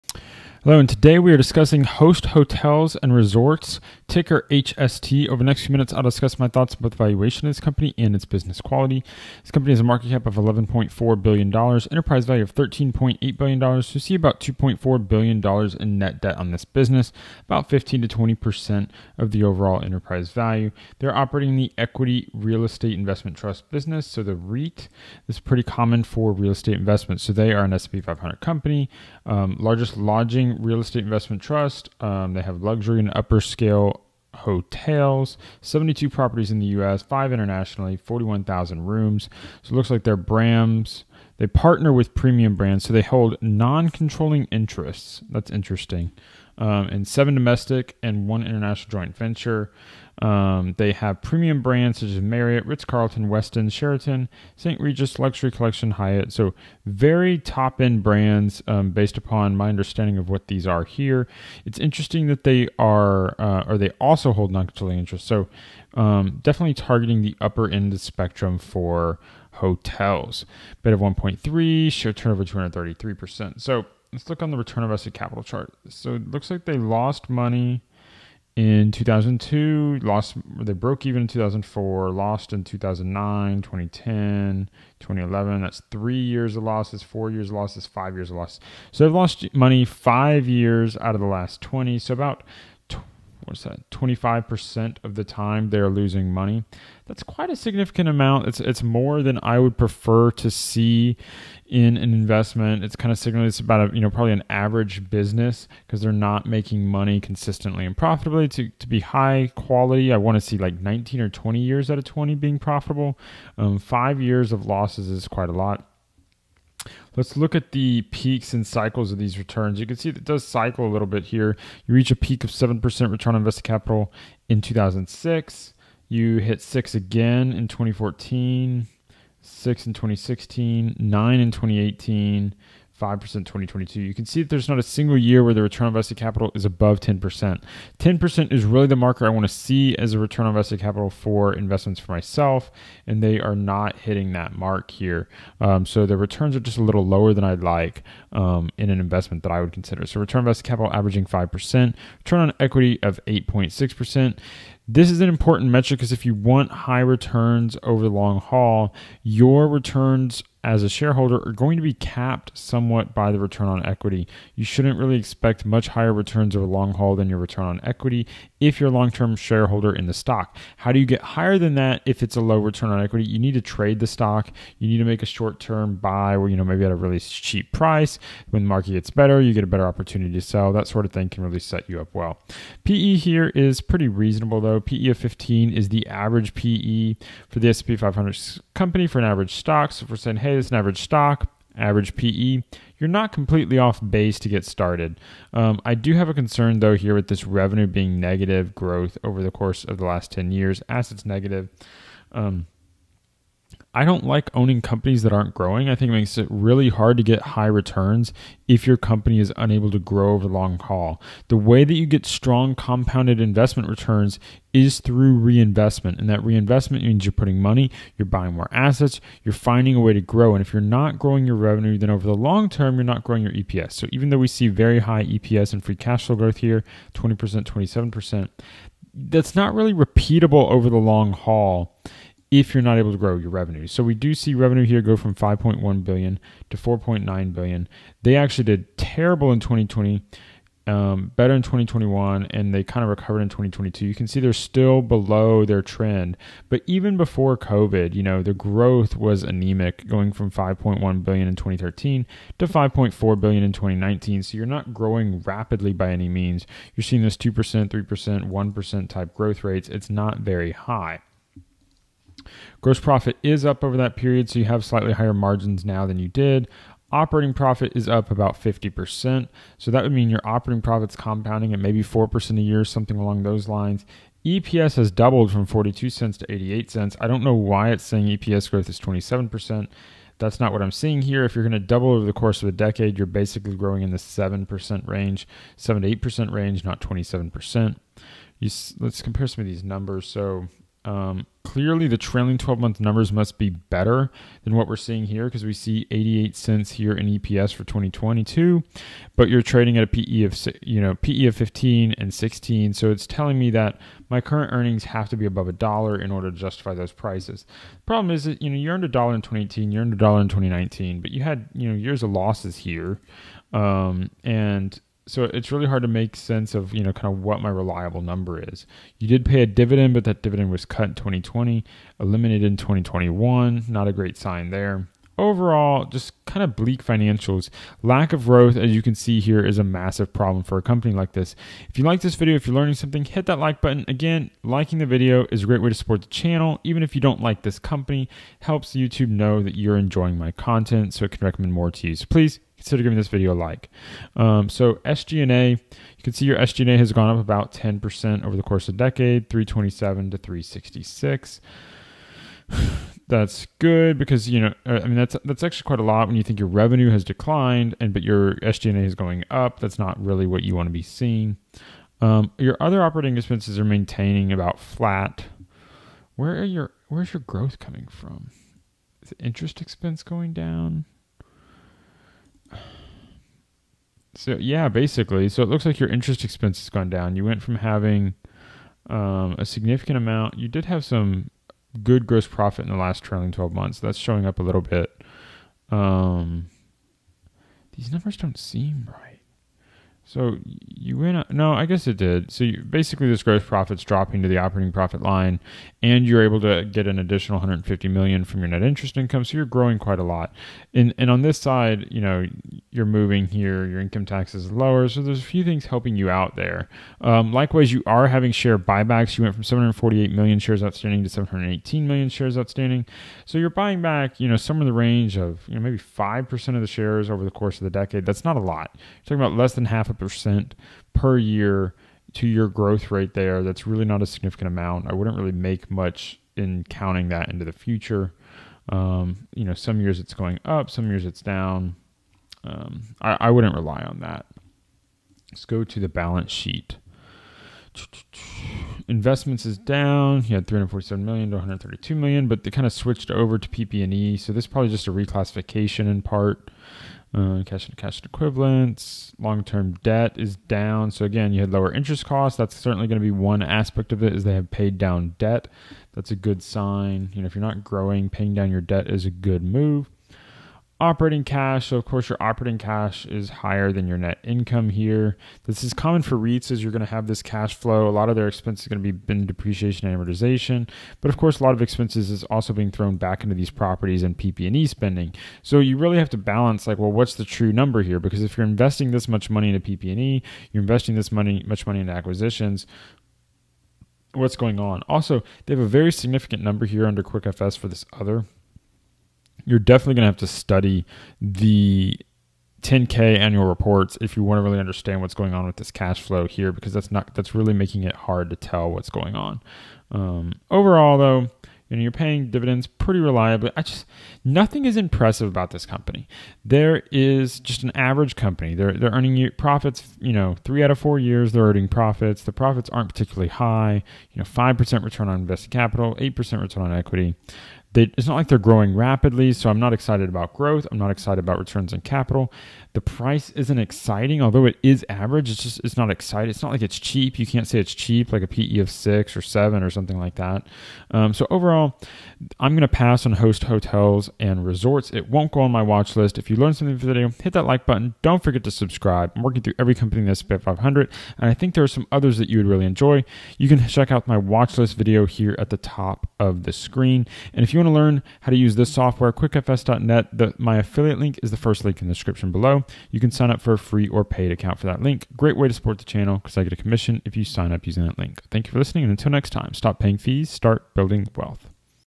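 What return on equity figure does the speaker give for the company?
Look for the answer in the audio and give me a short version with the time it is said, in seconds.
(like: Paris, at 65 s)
8.6%, at 153 s.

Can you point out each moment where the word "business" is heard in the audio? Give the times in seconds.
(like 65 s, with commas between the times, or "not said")
8 s, 16 s, 23 s, 105 s.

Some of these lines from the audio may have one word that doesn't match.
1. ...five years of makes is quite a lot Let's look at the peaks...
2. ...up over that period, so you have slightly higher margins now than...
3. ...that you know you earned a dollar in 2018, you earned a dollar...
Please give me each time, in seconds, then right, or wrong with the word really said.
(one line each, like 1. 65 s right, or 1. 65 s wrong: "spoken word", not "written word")
1. 113 s wrong: "losses", not "makes"
2. 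263 s right
3. 308 s right.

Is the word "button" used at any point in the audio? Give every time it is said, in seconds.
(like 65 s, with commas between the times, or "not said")
333 s, 537 s.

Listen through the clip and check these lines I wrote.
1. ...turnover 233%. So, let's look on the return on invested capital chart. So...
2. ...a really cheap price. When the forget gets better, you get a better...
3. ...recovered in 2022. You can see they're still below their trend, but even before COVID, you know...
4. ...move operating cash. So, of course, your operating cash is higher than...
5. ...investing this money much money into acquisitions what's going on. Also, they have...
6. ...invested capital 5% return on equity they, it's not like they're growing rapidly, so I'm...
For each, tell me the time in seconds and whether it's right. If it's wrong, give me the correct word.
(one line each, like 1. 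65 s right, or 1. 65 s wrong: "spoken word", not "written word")
1. 72 s right
2. 176 s wrong: "market", not "forget"
3. 243 s right
4. 459 s right
5. 480 s right
6. 515 s wrong: "8", not "5".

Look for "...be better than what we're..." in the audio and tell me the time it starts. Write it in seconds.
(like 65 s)
293 s.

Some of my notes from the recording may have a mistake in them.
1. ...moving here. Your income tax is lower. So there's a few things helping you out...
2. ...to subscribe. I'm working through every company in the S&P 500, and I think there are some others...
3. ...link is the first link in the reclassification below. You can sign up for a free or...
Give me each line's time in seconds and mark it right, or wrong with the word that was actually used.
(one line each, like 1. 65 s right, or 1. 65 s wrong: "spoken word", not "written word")
1. 403 s right
2. 538 s right
3. 551 s wrong: "description", not "reclassification".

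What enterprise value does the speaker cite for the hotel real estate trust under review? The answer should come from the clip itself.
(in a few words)
$13.8 billion.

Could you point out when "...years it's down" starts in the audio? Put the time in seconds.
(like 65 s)
431 s.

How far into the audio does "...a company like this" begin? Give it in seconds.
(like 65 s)
330 s.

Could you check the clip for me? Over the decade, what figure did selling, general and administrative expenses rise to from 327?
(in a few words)
366.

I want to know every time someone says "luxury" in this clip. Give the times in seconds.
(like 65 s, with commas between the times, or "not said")
32 s, 55 s.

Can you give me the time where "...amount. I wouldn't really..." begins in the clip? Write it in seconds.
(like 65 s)
424 s.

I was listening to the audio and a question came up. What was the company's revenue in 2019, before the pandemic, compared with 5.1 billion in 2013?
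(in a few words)
5.4 billion.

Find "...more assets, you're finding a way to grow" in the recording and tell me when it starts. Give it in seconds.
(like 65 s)
218 s.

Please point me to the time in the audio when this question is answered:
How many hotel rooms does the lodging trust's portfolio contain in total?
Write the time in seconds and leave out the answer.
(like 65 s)
37 s.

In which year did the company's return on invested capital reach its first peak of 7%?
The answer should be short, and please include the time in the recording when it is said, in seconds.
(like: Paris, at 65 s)
2006, at 124 s.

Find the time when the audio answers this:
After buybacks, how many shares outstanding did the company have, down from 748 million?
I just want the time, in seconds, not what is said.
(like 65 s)
411 s.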